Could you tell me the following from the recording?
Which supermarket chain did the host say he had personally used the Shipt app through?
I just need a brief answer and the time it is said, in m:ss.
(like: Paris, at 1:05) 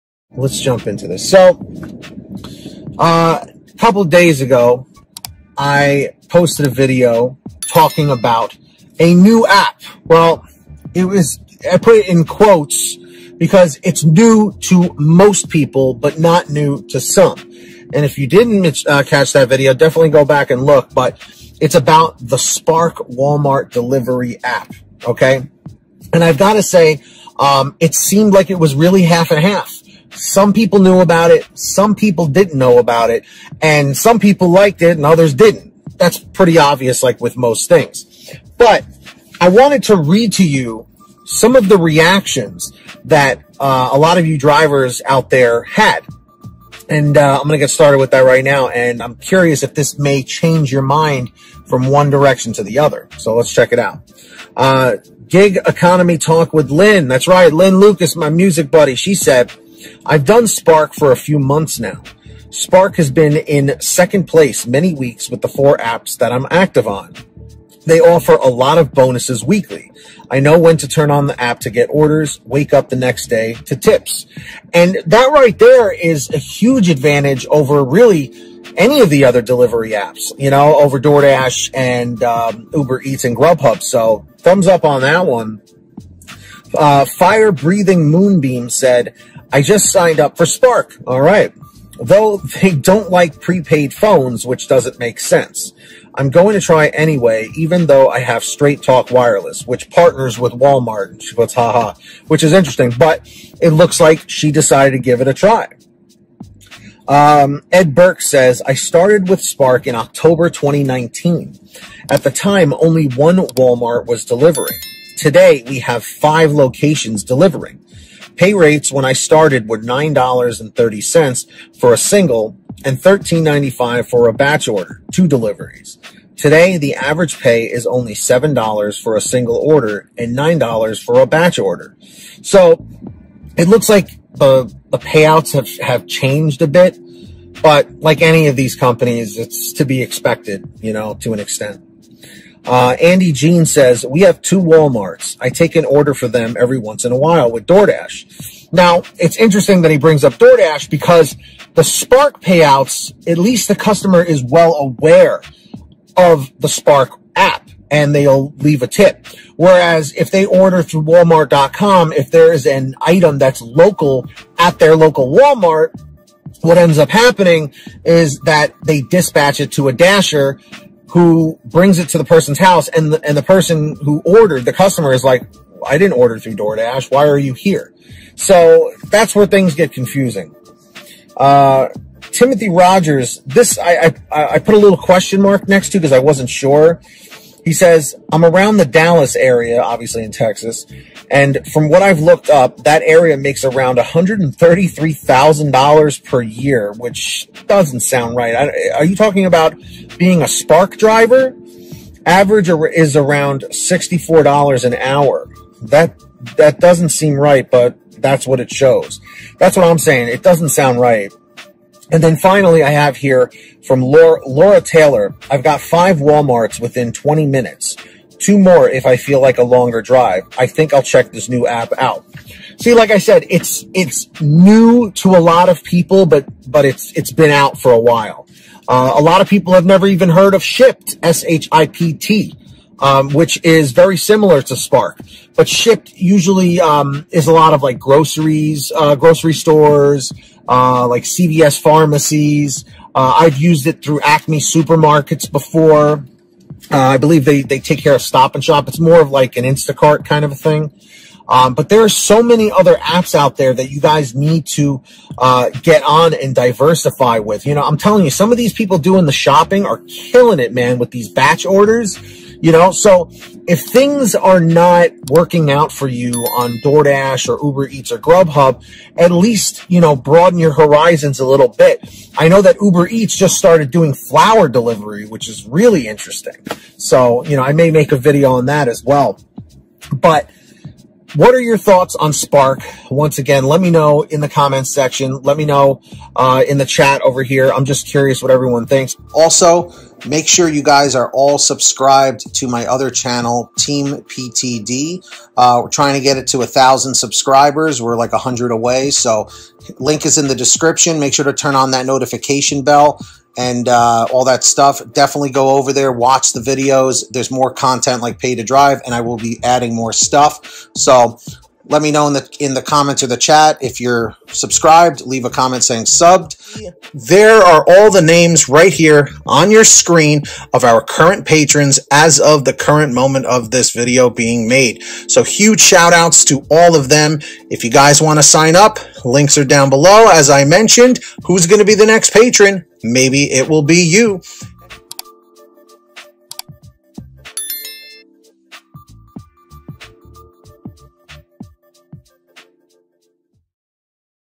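Acme, at 4:04.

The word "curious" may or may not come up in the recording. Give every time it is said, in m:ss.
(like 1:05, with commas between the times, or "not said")
0:49, 4:48.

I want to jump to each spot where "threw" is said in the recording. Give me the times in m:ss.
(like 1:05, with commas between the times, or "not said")
not said.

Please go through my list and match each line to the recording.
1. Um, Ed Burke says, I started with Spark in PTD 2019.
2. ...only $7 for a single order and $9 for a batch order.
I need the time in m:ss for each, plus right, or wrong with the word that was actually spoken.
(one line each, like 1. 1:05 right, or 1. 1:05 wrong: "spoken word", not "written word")
1. 1:47 wrong: "October", not "PTD"
2. 2:07 right.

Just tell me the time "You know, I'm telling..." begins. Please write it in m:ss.
4:17.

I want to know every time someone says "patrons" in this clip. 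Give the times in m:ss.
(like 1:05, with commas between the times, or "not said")
5:21, 5:32.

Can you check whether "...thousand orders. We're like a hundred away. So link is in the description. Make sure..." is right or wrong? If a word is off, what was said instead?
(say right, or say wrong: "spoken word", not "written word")
wrong: "subscribers", not "orders".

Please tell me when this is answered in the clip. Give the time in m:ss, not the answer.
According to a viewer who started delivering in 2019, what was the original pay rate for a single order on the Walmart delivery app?
1:59.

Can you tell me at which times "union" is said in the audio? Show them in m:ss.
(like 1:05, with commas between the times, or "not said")
not said.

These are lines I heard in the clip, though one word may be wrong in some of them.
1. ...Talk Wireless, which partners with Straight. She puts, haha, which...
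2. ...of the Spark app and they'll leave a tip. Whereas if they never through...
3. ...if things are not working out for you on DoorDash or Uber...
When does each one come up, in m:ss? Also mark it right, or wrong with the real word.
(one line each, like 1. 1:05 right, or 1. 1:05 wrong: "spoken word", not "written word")
1. 1:38 wrong: "Walmart", not "Straight"
2. 2:36 wrong: "order", not "never"
3. 4:23 right.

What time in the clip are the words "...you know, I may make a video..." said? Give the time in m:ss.
4:37.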